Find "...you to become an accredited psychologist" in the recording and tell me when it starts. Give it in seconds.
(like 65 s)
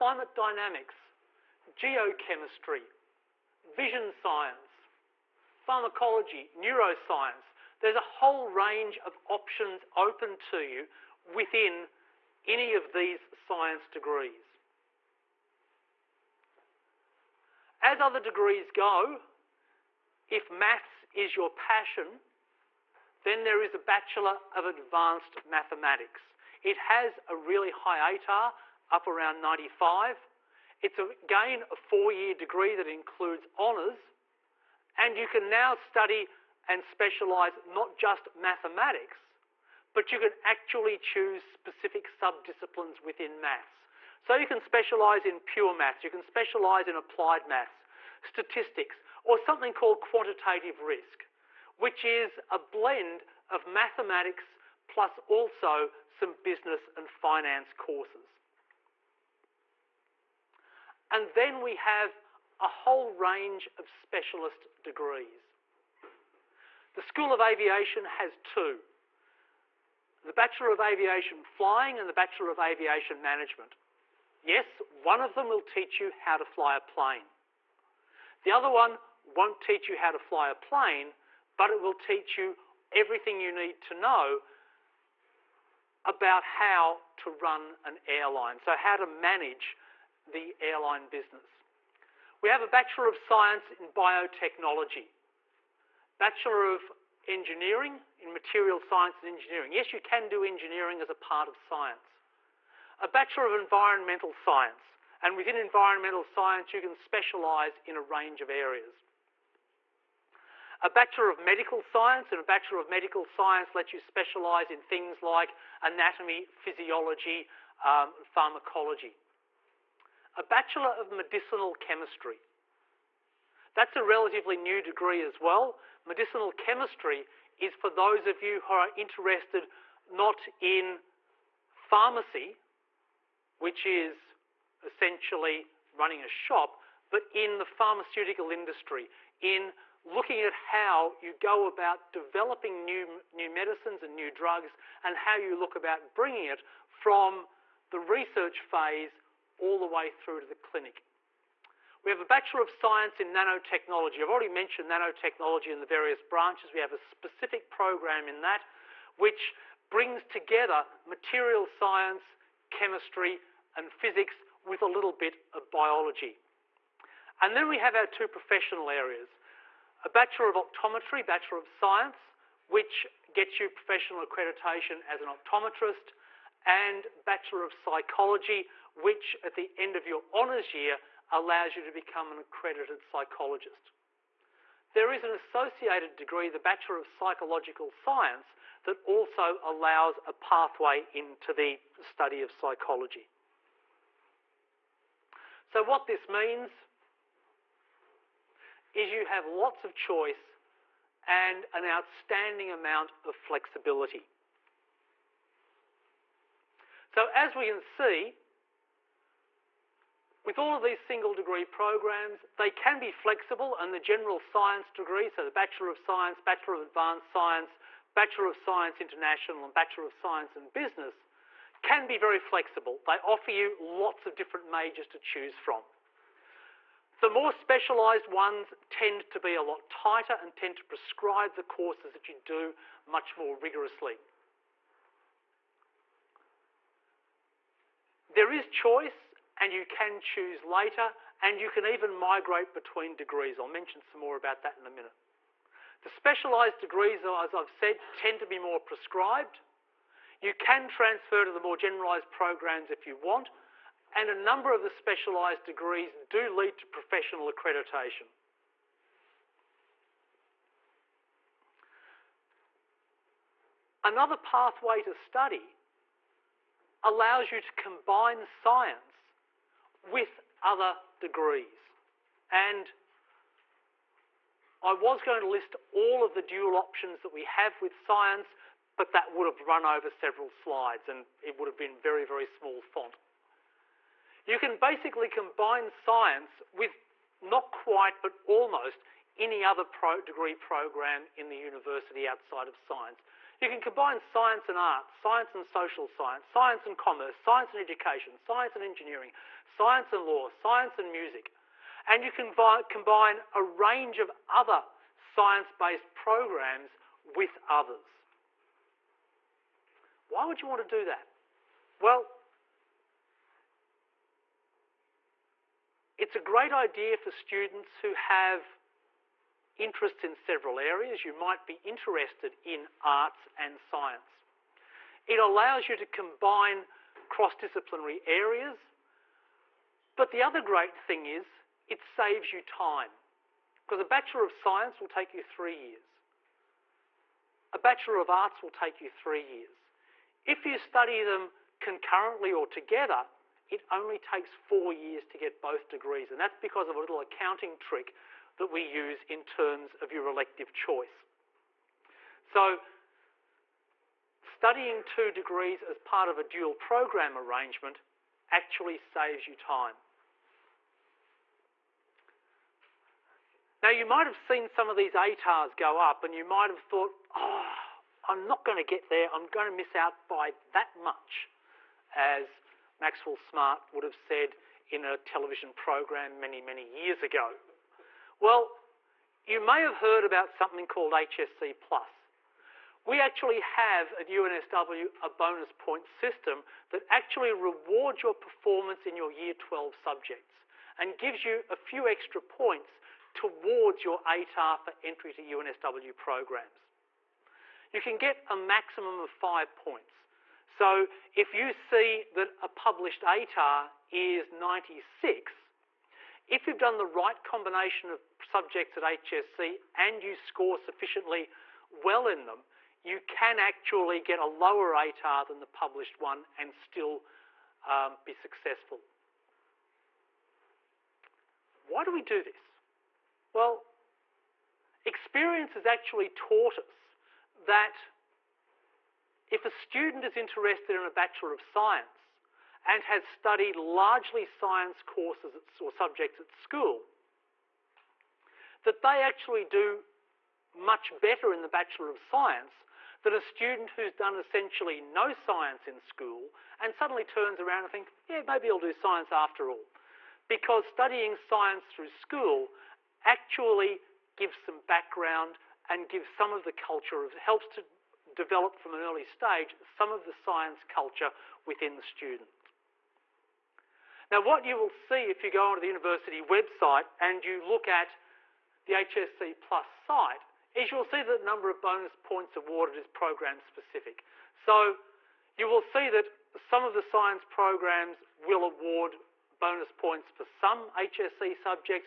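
181 s.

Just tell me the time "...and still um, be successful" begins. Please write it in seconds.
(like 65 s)
416 s.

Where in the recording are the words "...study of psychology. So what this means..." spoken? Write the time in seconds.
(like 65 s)
191 s.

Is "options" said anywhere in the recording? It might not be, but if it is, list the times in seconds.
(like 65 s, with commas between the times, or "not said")
9 s, 276 s.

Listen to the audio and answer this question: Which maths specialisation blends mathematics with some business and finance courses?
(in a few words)
Quantitative risk.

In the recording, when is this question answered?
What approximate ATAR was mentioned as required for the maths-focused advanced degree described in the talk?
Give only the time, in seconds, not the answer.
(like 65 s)
28 s.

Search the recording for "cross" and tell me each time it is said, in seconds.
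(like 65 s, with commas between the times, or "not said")
327 s.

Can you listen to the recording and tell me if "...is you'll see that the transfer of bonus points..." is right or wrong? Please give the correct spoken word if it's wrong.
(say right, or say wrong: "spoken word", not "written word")
wrong: "number", not "transfer".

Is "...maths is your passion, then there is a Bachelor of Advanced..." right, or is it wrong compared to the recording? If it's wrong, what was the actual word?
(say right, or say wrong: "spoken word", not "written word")
right.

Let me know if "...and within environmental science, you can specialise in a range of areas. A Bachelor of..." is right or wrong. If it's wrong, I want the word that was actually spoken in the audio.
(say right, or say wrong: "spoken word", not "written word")
right.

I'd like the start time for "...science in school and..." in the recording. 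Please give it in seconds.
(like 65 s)
445 s.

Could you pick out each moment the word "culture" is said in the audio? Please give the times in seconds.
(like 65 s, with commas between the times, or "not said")
456 s, 460 s.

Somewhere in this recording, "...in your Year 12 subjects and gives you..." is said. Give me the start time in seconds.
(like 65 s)
389 s.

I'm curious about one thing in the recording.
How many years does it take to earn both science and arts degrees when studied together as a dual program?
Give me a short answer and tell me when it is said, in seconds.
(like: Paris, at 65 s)
4, at 344 s.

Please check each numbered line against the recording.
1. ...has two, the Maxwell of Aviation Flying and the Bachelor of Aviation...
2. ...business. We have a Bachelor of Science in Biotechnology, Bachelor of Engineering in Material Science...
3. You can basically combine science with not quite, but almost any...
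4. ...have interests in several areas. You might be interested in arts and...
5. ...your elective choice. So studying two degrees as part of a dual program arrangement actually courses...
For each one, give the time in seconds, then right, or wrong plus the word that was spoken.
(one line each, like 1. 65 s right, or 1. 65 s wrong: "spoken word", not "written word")
1. 68 s wrong: "Bachelor", not "Maxwell"
2. 91 s right
3. 284 s right
4. 318 s right
5. 350 s wrong: "saves", not "courses".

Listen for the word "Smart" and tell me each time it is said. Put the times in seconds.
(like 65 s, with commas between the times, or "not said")
373 s.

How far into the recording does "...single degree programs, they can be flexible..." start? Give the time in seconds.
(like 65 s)
211 s.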